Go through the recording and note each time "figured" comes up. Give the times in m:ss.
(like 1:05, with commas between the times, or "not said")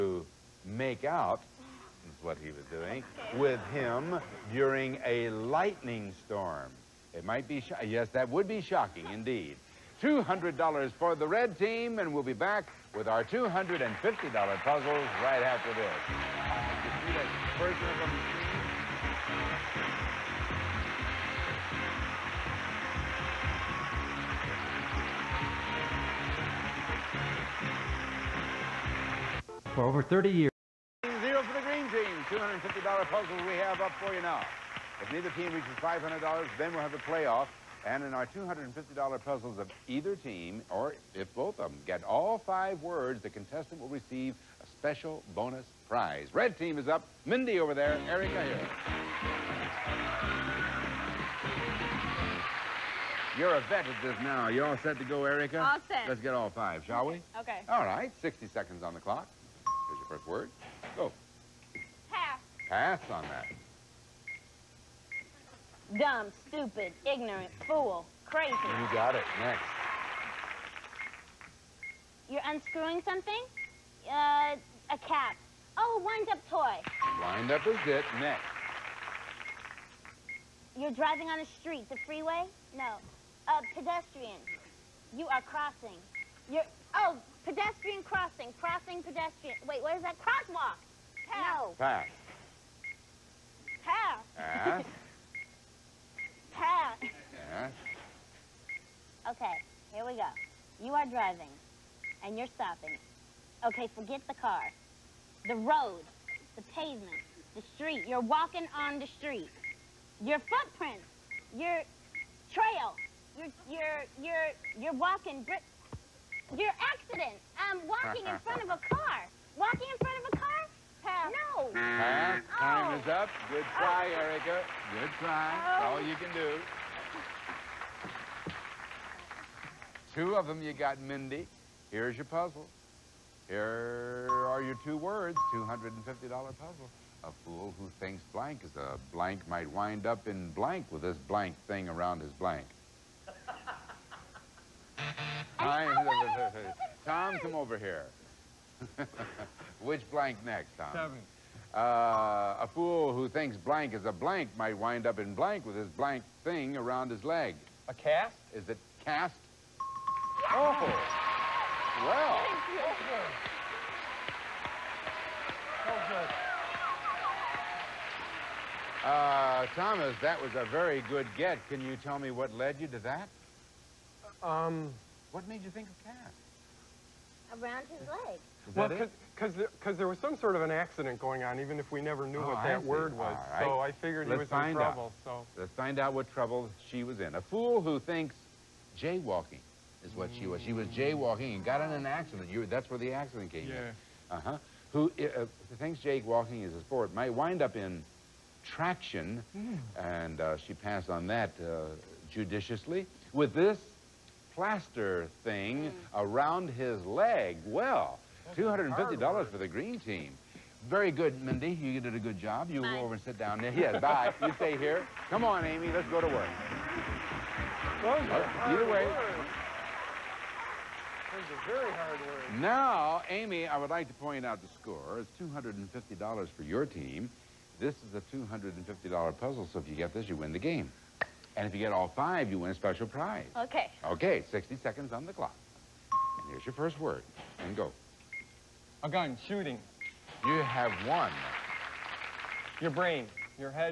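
3:03.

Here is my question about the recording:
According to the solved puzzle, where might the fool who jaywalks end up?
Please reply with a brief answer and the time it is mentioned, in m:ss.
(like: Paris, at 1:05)
In traction, at 3:17.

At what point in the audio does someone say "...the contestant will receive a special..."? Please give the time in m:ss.
0:43.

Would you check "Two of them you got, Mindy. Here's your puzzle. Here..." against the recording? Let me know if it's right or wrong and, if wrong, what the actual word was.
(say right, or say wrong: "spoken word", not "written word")
right.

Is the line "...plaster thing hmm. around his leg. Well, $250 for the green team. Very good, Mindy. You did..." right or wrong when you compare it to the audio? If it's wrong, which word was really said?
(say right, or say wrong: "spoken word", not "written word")
right.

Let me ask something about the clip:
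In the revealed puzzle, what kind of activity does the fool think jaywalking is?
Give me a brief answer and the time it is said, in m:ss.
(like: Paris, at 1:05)
A sport, at 3:16.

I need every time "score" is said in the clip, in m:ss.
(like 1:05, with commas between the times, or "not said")
3:44.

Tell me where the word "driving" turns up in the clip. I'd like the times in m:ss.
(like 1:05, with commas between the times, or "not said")
1:20, 1:41.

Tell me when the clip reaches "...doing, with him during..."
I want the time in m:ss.
0:02.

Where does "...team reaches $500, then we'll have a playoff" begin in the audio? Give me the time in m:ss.
0:35.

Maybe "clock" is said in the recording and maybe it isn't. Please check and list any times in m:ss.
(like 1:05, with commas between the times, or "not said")
0:58, 3:55.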